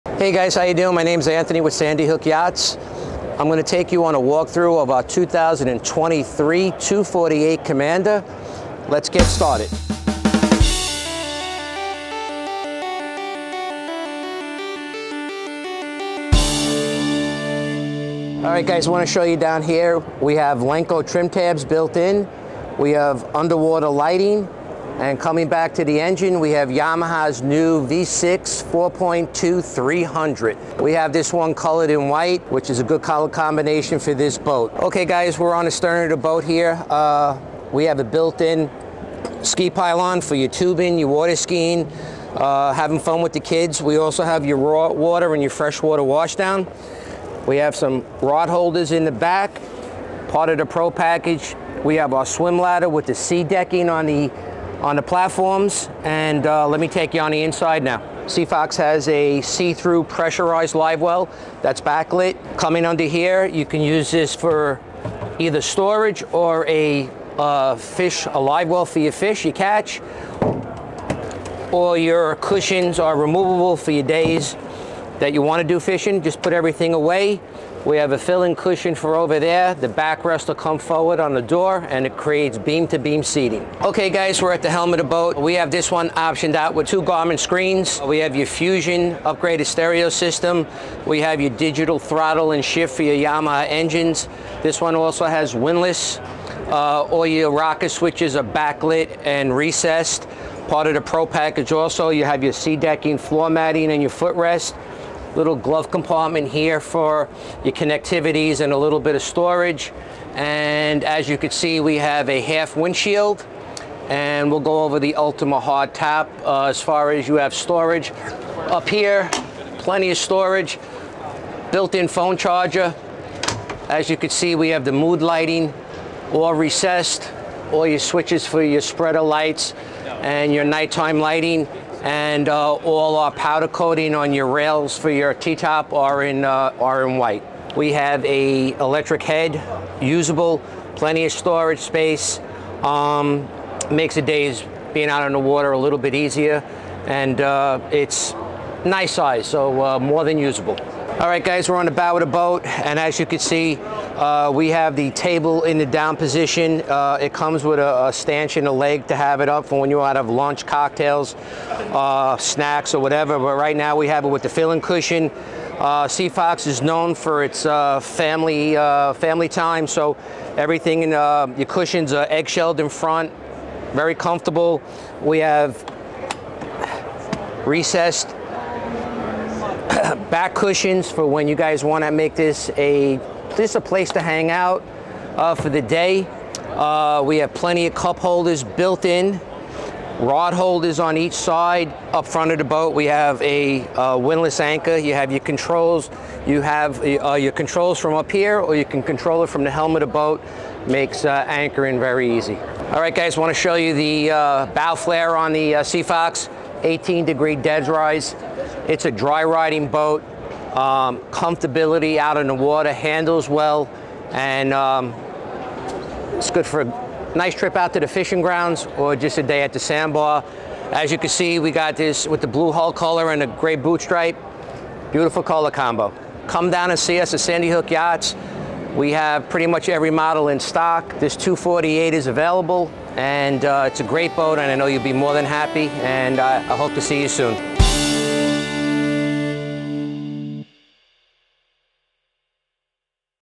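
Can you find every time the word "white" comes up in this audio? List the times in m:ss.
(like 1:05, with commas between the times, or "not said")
0:32, 2:17.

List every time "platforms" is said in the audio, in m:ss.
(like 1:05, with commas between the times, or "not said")
0:55.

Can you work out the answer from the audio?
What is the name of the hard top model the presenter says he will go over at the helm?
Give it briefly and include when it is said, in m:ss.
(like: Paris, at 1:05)
Ultima, at 1:55.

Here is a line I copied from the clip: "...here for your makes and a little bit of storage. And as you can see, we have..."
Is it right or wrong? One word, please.
wrong.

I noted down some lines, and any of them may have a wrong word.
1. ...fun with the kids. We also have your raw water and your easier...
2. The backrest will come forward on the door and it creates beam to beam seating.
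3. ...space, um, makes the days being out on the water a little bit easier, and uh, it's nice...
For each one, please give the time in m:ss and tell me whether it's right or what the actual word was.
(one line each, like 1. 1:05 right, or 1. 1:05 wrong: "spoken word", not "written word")
1. 0:42 wrong: "freshwater", not "easier"
2. 1:19 right
3. 2:21 right.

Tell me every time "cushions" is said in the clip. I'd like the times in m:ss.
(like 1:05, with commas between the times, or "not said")
1:12, 1:18, 2:44, 2:51, 3:00.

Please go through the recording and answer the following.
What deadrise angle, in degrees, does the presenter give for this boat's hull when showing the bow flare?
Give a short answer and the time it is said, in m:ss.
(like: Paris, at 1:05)
18 degrees, at 3:26.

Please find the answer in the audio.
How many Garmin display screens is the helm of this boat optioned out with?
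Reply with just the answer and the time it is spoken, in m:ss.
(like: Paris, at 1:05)
2, at 1:26.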